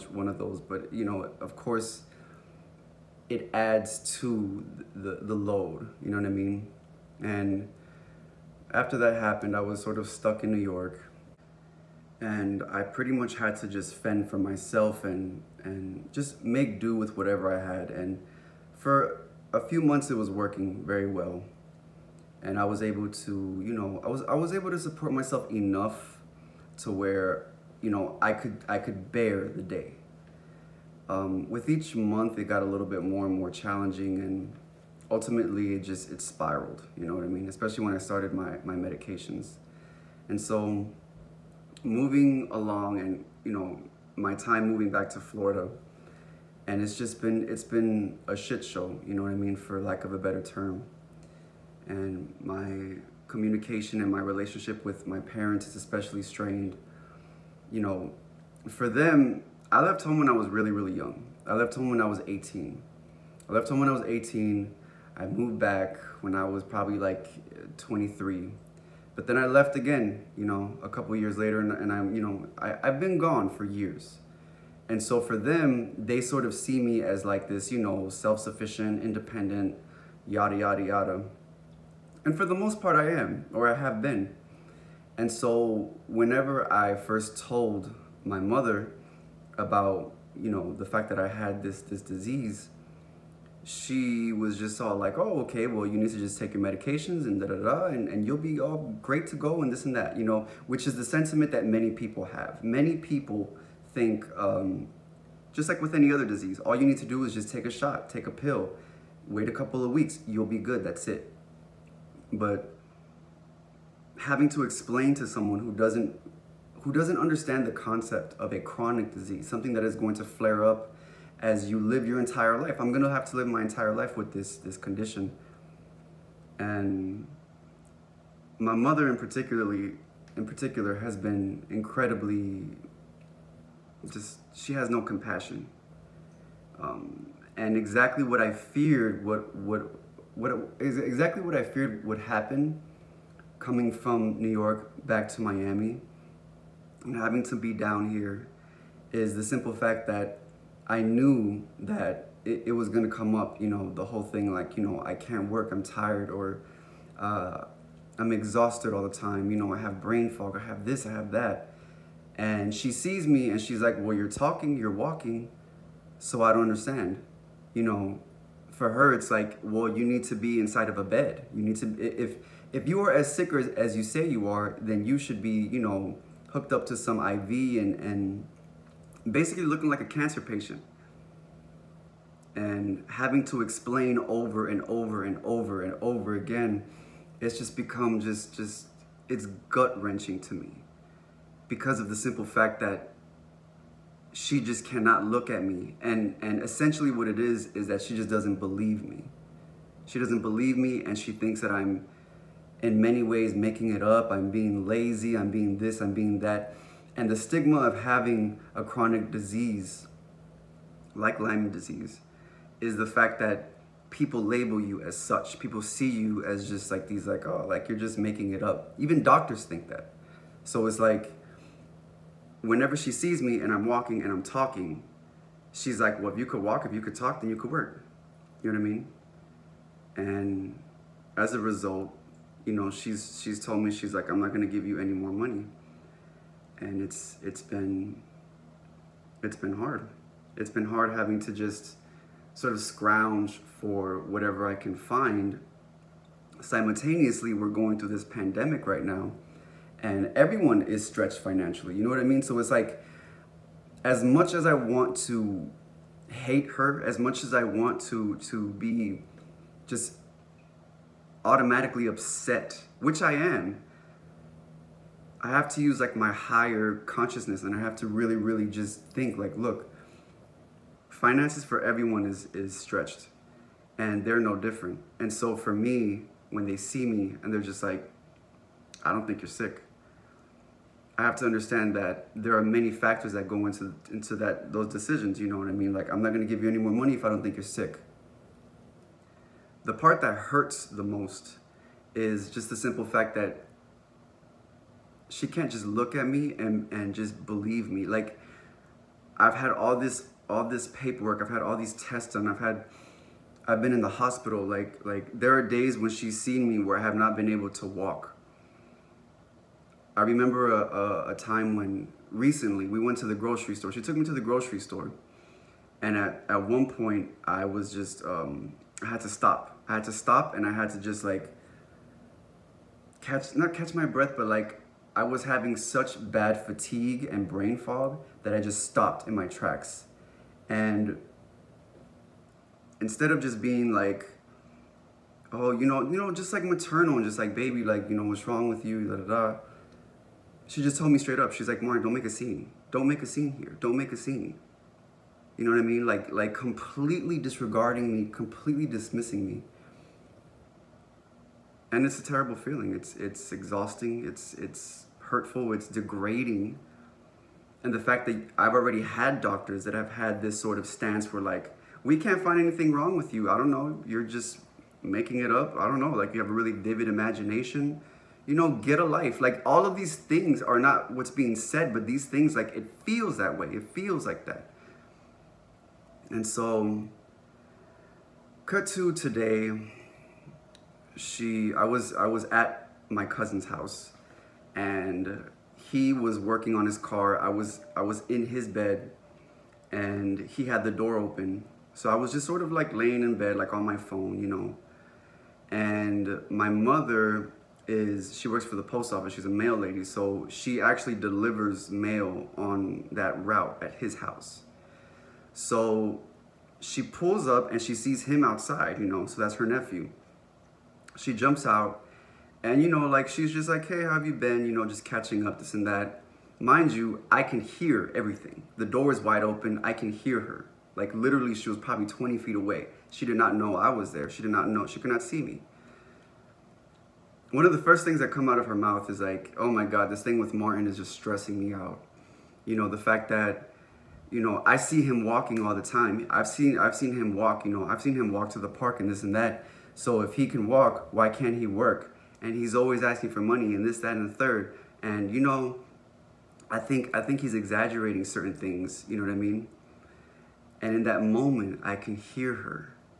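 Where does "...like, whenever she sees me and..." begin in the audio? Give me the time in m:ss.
3:40.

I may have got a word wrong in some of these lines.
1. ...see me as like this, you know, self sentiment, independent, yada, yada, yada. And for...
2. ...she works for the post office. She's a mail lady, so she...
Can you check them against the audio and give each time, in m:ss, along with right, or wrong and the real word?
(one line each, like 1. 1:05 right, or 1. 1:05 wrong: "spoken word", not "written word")
1. 1:16 wrong: "sufficient", not "sentiment"
2. 6:38 right.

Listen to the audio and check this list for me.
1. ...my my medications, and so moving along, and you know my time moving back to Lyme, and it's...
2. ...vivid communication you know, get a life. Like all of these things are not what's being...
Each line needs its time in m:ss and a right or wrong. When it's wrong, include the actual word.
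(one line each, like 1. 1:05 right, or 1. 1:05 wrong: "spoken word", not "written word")
1. 0:38 wrong: "Florida", not "Lyme"
2. 6:06 wrong: "imagination", not "communication".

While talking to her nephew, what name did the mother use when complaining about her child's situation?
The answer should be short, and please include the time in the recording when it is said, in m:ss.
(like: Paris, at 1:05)
Martin, at 7:10.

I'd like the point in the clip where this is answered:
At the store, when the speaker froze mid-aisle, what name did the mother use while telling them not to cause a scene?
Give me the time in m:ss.
5:41.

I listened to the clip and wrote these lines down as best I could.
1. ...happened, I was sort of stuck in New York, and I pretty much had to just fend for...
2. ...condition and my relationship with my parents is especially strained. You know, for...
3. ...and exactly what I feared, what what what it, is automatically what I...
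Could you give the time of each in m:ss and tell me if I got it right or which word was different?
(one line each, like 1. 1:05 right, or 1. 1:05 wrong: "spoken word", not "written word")
1. 0:09 right
2. 0:53 wrong: "communication", not "condition"
3. 2:17 wrong: "exactly", not "automatically".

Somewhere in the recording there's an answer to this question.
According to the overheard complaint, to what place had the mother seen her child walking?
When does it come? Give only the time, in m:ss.
7:18.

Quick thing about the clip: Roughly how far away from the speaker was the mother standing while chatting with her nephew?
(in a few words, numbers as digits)
20 feet.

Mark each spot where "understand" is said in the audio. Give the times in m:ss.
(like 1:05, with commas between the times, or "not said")
1:57, 2:46, 4:41.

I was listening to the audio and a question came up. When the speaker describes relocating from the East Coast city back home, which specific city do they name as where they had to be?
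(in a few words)
Miami.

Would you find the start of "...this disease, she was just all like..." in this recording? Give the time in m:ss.
1:31.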